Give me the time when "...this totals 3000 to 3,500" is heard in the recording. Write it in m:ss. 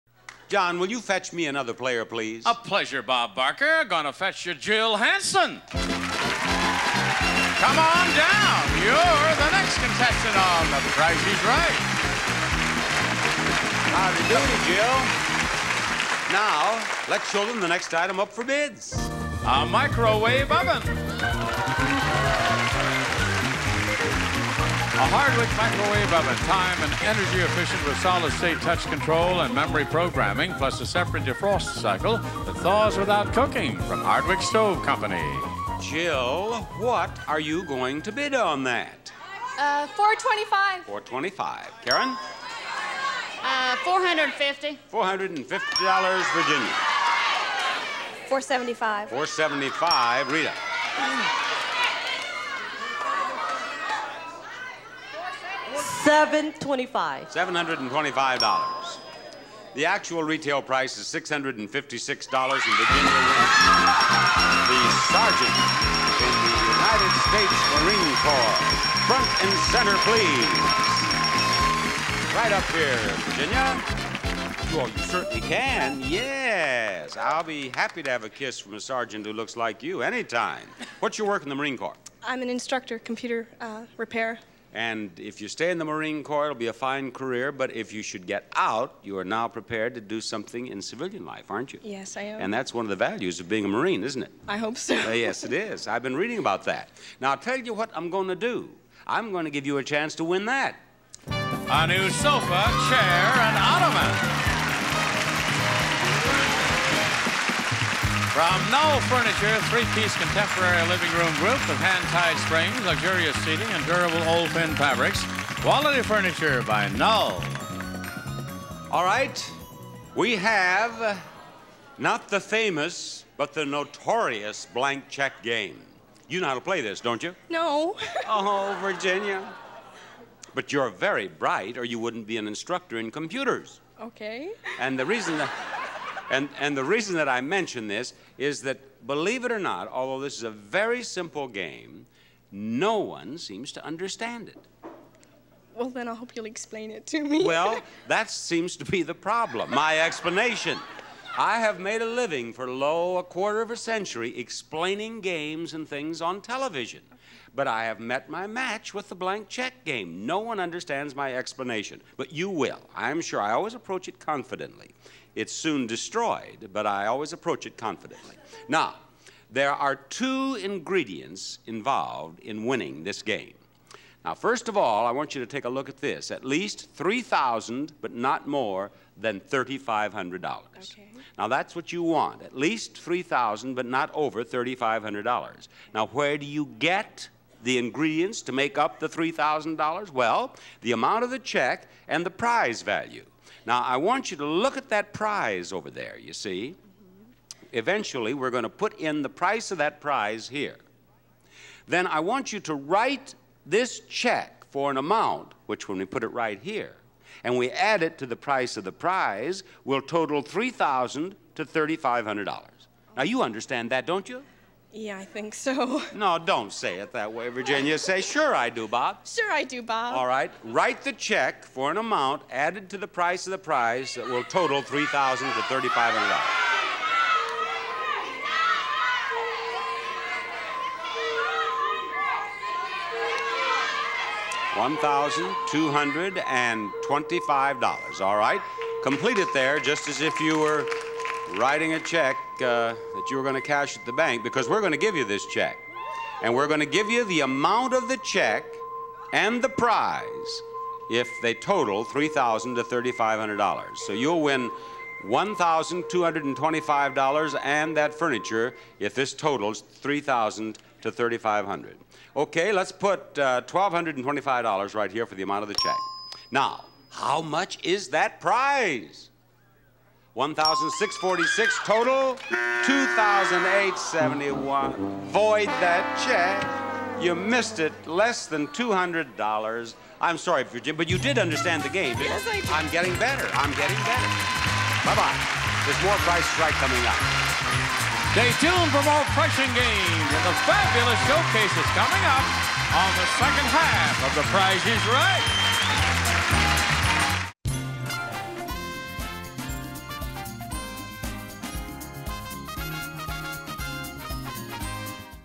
4:19.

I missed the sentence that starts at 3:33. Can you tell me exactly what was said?
Now, you understand that, don't you?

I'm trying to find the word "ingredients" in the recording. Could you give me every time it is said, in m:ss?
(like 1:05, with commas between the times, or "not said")
2:50, 3:07.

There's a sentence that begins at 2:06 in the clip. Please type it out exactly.
You know how to play this, don't you?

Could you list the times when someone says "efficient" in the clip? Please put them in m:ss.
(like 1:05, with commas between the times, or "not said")
0:27.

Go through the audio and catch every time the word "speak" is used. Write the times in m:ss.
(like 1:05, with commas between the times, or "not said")
not said.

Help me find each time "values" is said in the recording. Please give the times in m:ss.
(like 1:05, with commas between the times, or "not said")
1:32, 3:12.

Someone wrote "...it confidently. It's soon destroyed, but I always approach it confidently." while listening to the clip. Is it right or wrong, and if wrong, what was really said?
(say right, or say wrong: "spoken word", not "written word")
right.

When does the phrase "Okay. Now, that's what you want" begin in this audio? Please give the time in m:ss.
3:00.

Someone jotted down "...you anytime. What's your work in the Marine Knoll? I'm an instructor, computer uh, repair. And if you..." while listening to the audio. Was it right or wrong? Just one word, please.
wrong.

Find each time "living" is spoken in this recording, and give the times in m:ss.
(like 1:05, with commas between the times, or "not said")
1:50, 2:32.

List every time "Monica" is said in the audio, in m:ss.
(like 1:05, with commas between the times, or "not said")
not said.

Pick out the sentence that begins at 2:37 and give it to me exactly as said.
But I have met my match with the blank check game.